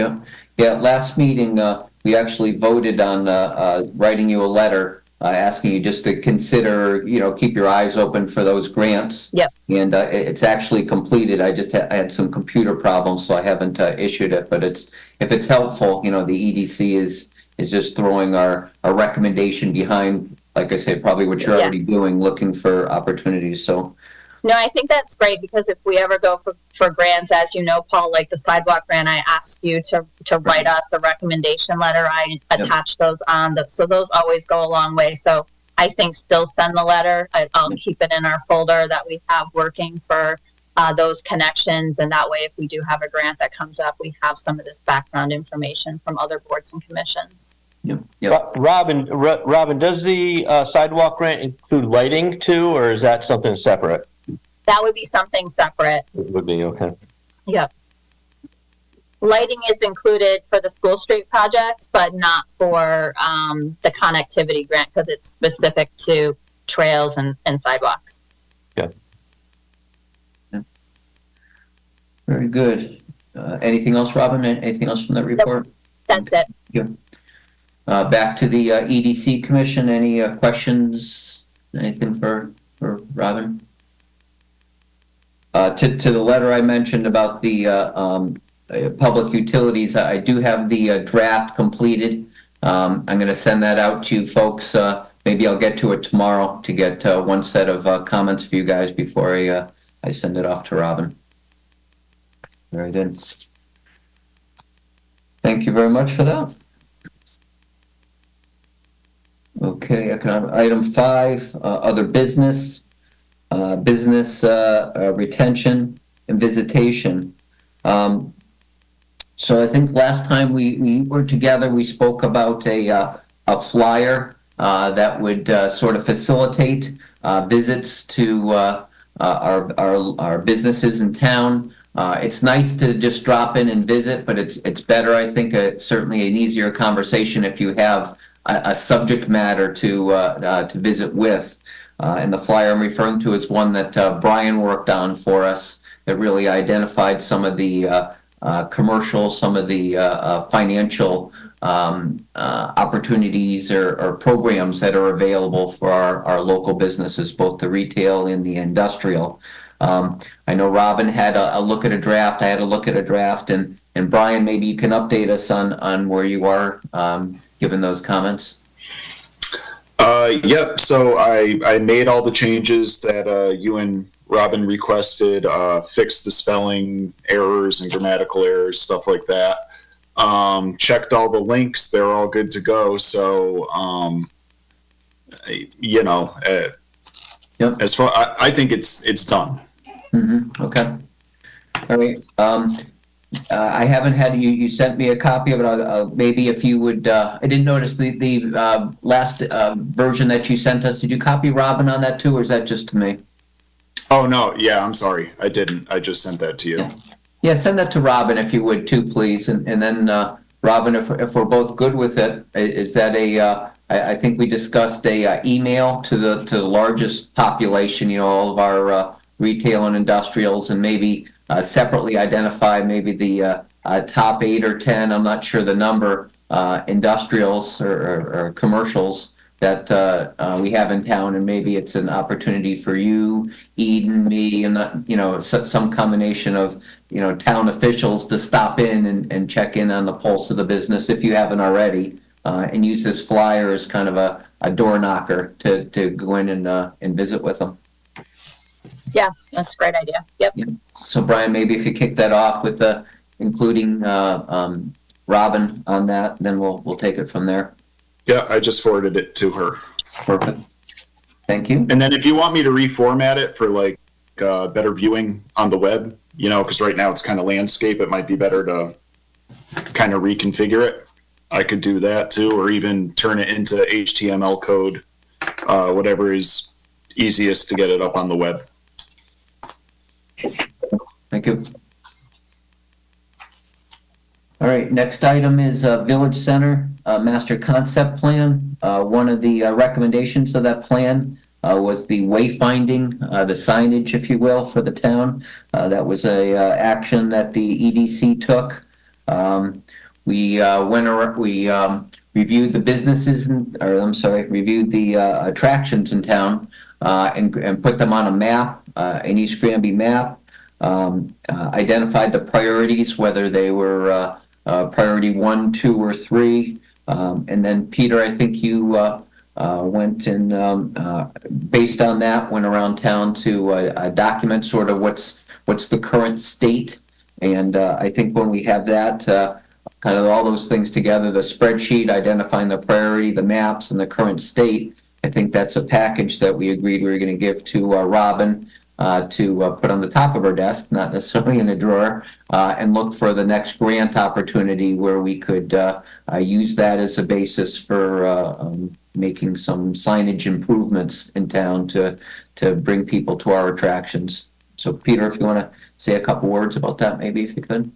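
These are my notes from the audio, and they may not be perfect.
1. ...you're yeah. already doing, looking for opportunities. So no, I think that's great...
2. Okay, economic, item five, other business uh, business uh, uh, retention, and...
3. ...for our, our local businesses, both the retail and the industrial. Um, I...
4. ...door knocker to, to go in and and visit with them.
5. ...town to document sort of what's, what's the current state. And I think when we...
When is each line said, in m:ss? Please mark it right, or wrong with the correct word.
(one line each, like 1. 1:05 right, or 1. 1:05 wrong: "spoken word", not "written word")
1. 0:21 right
2. 1:49 right
3. 2:35 right
4. 4:04 right
5. 5:22 right.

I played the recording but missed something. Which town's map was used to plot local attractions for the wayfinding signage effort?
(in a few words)
East Granby.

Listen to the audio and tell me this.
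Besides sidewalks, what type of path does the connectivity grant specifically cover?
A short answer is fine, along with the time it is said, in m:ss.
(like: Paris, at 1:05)
Trails, at 1:06.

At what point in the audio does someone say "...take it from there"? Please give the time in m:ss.
4:16.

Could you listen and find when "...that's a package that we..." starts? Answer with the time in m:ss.
5:35.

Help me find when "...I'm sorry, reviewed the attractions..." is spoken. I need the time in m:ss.
5:03.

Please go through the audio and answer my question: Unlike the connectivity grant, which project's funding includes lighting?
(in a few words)
School street project.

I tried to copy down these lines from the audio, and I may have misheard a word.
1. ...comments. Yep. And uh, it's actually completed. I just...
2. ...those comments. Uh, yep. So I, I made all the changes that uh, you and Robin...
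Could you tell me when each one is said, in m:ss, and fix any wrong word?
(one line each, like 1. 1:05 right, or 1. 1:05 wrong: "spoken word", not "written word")
1. 0:08 wrong: "grants", not "comments"
2. 2:47 right.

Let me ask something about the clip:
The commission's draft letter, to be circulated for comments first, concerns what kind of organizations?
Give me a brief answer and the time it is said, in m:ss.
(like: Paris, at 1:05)
Public utilities, at 1:28.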